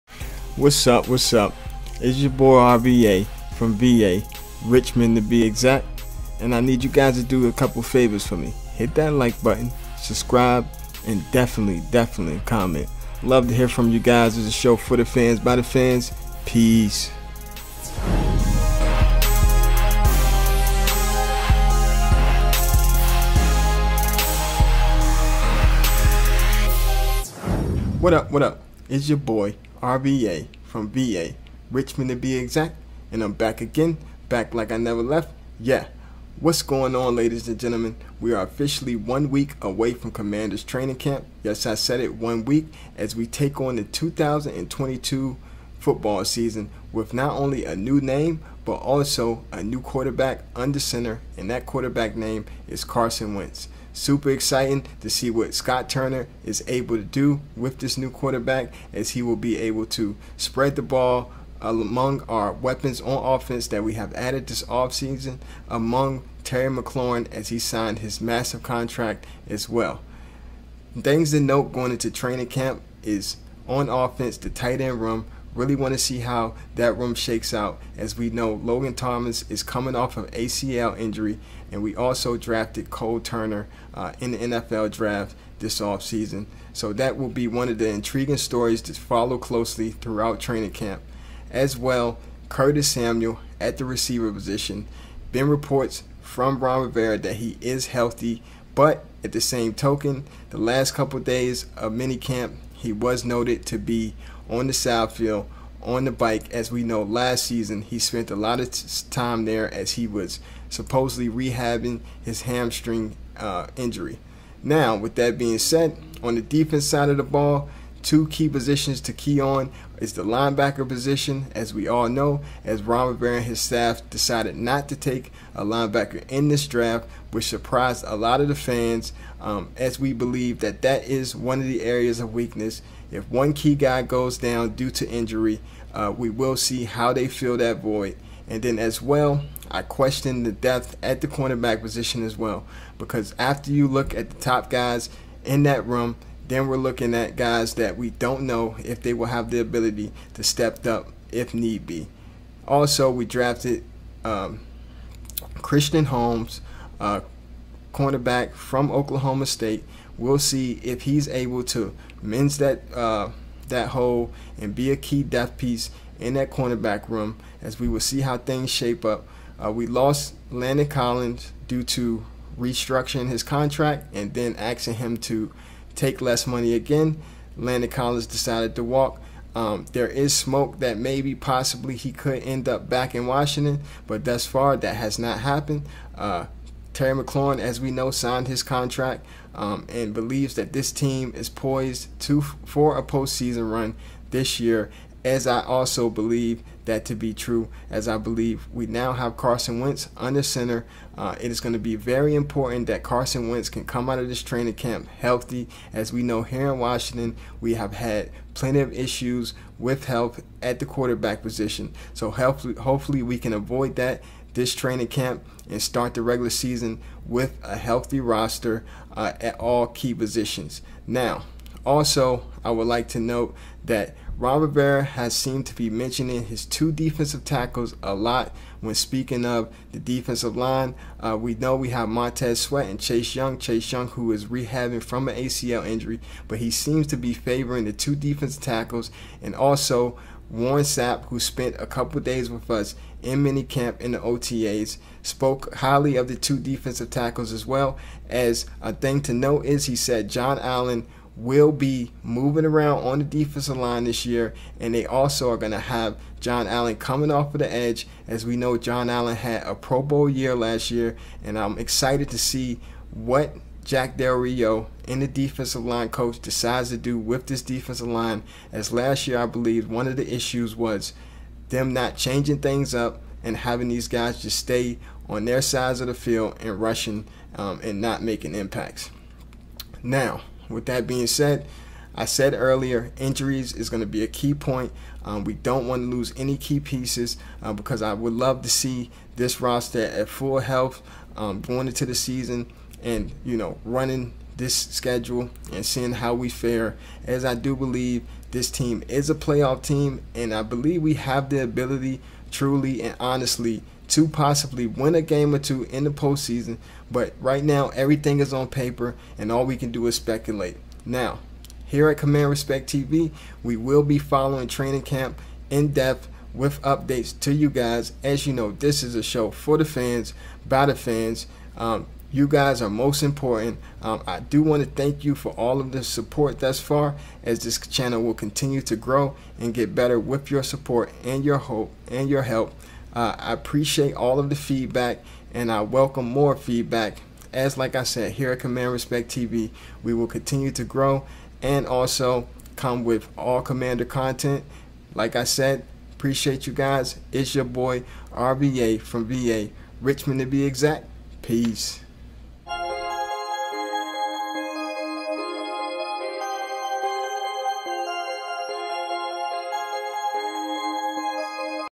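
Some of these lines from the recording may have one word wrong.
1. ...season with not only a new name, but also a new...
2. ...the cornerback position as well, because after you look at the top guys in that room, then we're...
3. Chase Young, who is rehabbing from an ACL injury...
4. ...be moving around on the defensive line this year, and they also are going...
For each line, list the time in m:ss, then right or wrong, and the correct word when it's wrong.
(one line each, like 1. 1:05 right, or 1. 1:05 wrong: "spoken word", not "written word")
1. 0:46 right
2. 2:21 right
3. 3:53 right
4. 4:11 right.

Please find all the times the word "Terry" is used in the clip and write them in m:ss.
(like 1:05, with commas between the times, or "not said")
1:06, 3:06.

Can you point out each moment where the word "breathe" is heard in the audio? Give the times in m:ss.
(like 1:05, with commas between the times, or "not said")
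not said.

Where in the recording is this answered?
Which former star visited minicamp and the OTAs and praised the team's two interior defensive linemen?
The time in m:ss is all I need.
4:00.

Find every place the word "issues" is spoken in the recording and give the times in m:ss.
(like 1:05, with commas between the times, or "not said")
3:28, 4:30.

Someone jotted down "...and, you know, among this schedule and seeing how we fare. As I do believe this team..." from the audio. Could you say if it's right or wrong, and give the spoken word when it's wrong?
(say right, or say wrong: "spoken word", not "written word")
wrong: "running", not "among".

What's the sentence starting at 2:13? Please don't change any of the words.
If one key guy goes down due to injury, uh, we will see how they fill that void.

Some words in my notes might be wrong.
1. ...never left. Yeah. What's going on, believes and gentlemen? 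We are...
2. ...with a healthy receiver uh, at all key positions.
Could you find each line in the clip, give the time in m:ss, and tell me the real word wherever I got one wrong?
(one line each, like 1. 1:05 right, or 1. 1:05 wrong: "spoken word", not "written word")
1. 0:34 wrong: "ladies", not "believes"
2. 3:37 wrong: "roster", not "receiver".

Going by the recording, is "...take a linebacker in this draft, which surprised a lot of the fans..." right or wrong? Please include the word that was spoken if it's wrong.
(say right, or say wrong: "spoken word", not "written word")
right.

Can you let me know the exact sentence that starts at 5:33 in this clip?
Uh, I appreciate all of the feedback and I welcome more feedback.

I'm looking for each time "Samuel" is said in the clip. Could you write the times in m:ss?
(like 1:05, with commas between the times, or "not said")
1:32.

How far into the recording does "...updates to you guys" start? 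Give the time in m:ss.
5:16.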